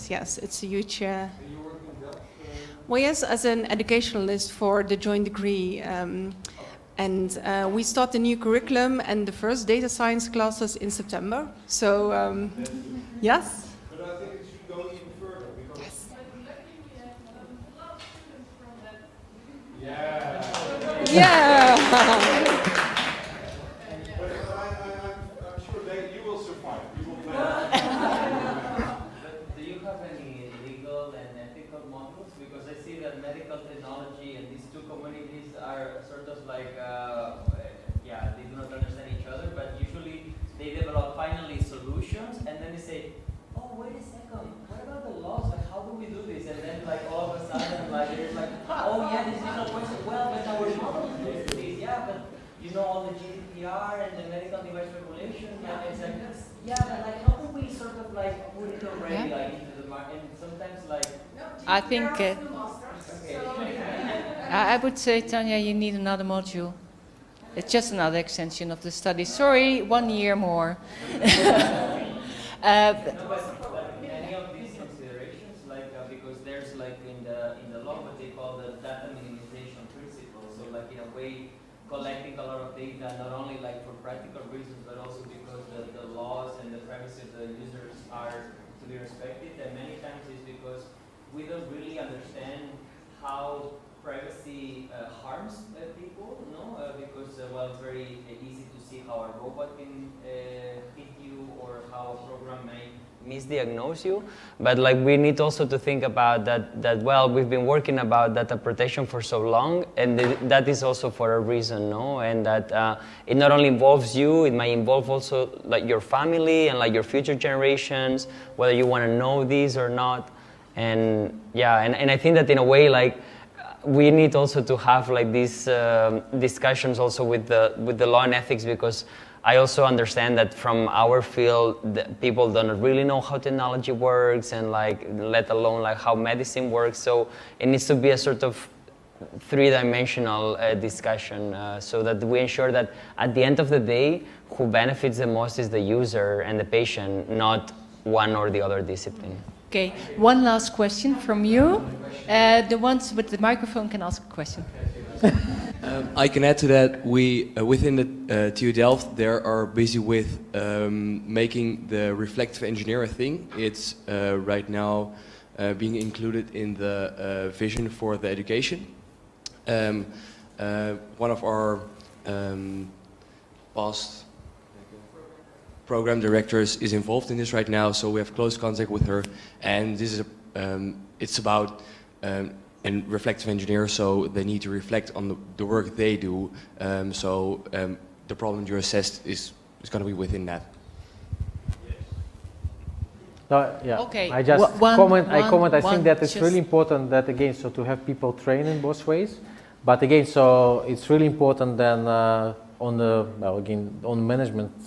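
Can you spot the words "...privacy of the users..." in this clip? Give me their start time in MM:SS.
01:26.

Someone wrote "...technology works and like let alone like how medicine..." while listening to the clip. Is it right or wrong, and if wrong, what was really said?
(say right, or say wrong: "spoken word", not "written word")
right.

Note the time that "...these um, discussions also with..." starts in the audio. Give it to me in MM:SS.
02:05.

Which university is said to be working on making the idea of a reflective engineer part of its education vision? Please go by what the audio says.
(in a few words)
TU Delft.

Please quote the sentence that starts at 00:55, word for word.
Yeah, it's like yeah, but like how do we sort of like put it already yeah.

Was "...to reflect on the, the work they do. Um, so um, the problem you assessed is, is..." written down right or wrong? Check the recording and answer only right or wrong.
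right.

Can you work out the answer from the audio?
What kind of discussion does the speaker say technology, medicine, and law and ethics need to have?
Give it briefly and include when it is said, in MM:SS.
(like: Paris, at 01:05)
three-dimensional, at 02:19.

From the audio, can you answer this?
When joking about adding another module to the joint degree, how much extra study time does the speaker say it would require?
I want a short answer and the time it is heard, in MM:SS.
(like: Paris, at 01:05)
one year, at 01:09.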